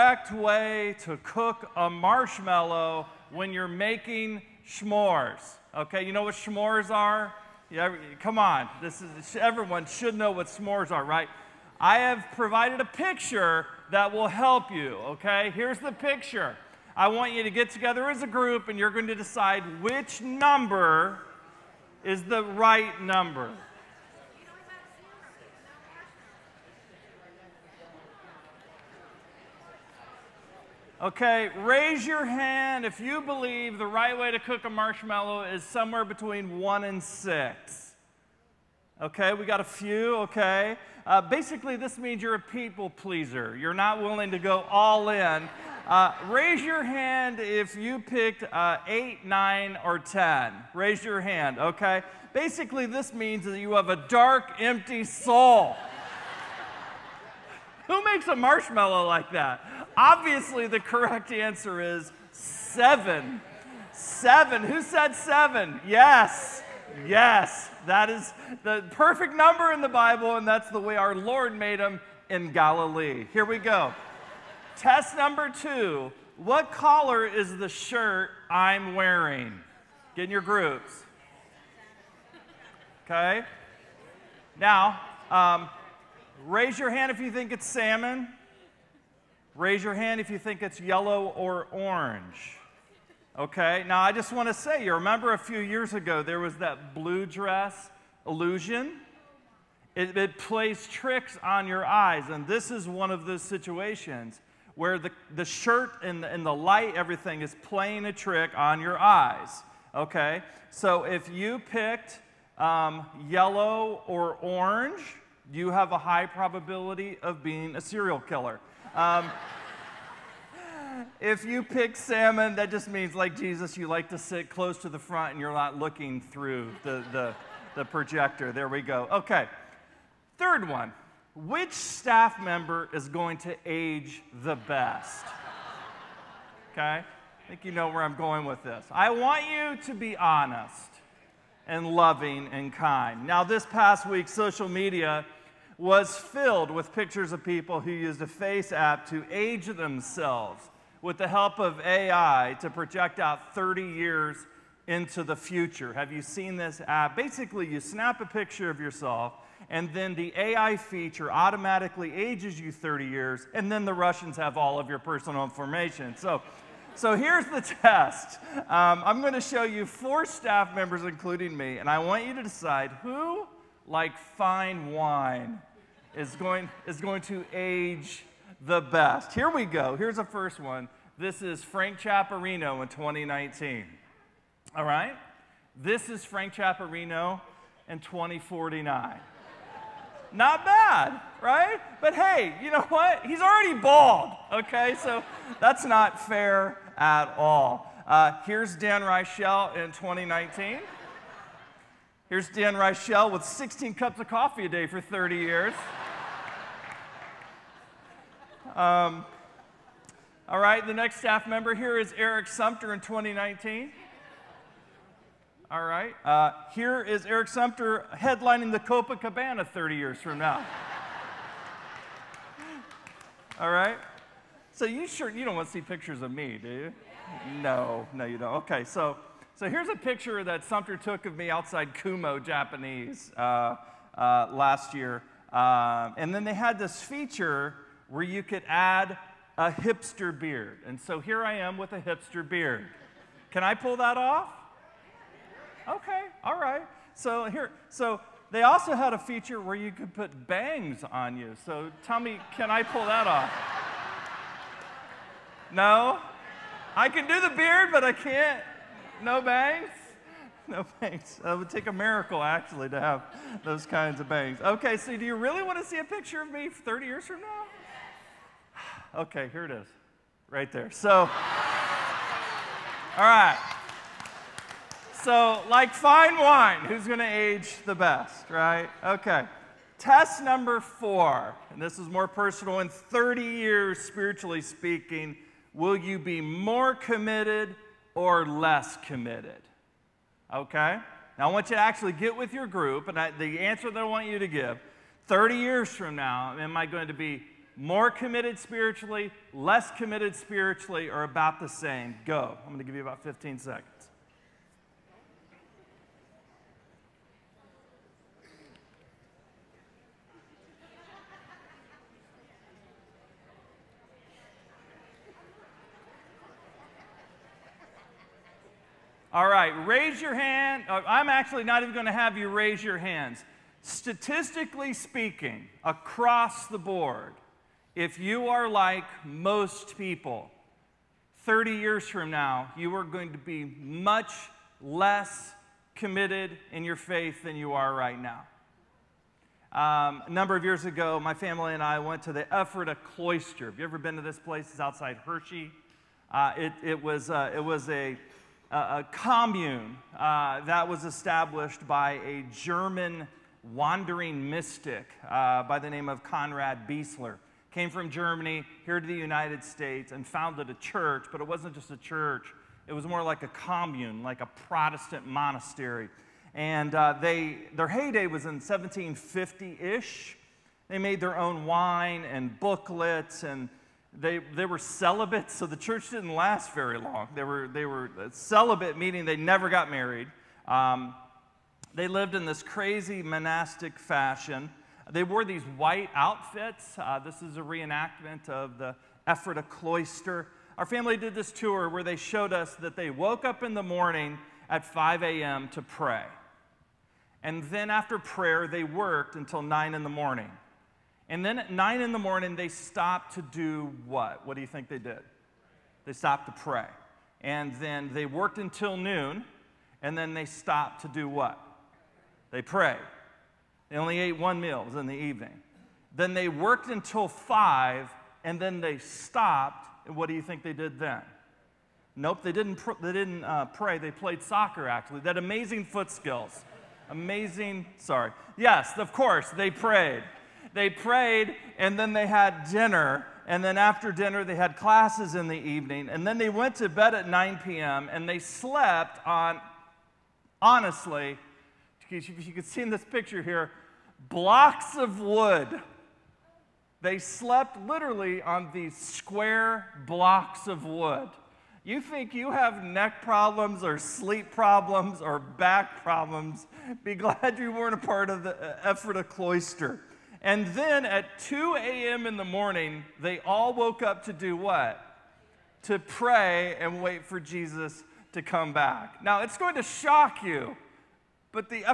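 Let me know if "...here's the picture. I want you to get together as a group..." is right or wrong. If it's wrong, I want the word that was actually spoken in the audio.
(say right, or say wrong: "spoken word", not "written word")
right.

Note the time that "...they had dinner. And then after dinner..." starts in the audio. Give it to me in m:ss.
7:12.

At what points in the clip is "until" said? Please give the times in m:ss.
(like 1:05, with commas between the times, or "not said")
6:39, 6:48, 6:56.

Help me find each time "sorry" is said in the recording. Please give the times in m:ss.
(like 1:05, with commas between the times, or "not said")
7:07.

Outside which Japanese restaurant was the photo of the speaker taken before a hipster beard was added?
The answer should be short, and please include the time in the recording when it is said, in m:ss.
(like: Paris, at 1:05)
Kumo, at 3:51.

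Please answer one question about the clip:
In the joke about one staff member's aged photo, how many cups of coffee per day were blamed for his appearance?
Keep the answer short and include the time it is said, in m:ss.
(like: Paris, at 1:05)
16, at 3:23.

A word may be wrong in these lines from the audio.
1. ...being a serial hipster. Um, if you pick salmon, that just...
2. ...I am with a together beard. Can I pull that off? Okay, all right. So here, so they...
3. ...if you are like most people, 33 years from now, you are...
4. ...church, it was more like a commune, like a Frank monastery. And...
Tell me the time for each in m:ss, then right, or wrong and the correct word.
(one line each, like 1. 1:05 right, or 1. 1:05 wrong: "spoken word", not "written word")
1. 1:57 wrong: "killer", not "hipster"
2. 4:01 wrong: "hipster", not "together"
3. 5:27 wrong: "30", not "33"
4. 6:01 wrong: "Protestant", not "Frank".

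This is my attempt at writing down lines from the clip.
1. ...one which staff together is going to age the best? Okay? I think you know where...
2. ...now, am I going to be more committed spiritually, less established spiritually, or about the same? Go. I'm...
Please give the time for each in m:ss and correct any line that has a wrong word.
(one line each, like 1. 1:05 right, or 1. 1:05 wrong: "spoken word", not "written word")
1. 2:10 wrong: "member", not "together"
2. 4:56 wrong: "committed", not "established".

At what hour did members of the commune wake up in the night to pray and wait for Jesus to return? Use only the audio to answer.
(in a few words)
2 a.m.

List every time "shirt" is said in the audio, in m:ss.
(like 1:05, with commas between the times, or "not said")
1:17, 1:45.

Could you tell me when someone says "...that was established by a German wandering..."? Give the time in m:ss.
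5:50.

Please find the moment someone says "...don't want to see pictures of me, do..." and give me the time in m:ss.
3:45.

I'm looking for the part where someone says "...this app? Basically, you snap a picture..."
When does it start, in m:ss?
2:36.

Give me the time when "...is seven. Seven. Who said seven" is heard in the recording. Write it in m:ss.
1:01.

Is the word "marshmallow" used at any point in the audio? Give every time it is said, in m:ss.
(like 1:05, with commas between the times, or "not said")
0:01, 0:34, 0:58.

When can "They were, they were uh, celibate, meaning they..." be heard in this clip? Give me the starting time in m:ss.
6:17.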